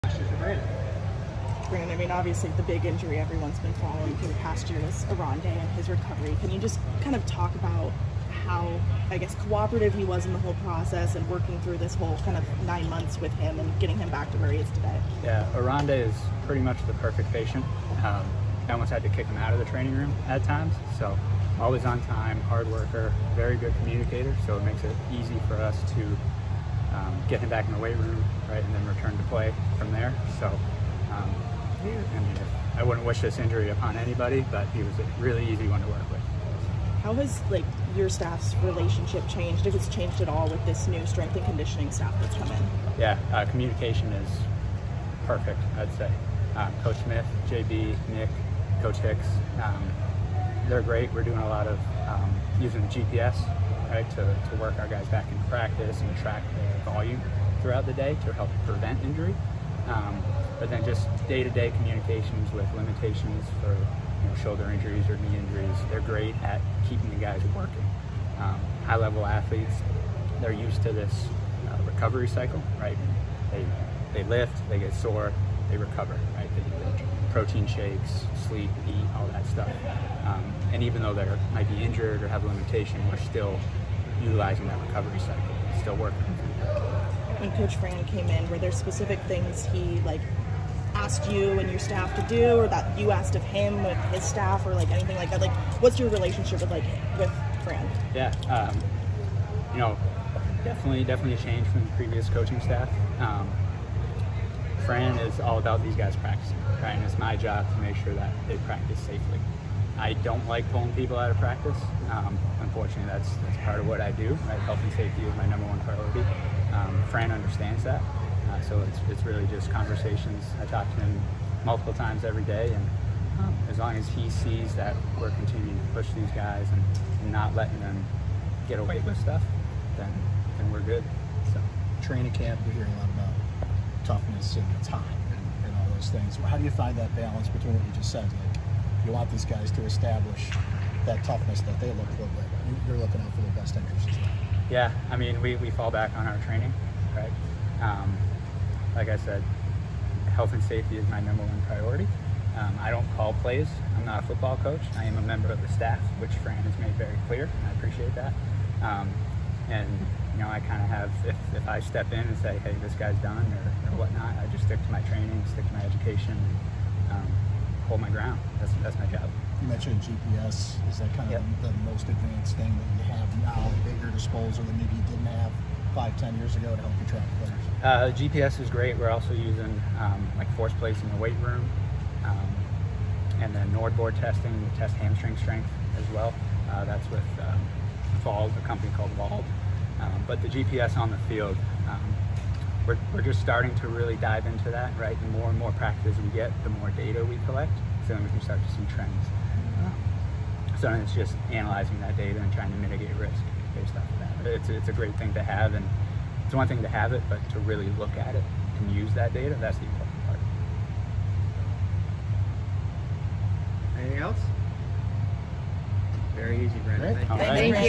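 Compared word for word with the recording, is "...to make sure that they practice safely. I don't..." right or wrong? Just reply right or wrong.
right.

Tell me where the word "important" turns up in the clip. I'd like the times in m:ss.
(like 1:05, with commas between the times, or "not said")
3:29.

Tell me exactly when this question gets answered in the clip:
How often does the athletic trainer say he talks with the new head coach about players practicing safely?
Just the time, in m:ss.
2:01.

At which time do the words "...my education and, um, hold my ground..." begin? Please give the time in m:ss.
2:45.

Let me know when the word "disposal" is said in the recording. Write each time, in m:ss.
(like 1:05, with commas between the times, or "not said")
2:54.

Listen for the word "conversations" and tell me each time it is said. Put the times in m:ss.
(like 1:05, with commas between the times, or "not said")
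1:59.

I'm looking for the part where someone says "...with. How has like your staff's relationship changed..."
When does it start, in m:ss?
0:36.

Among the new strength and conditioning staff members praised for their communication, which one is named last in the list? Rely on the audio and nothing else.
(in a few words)
Coach Hicks.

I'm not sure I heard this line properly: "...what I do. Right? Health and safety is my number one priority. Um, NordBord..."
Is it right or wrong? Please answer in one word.
wrong.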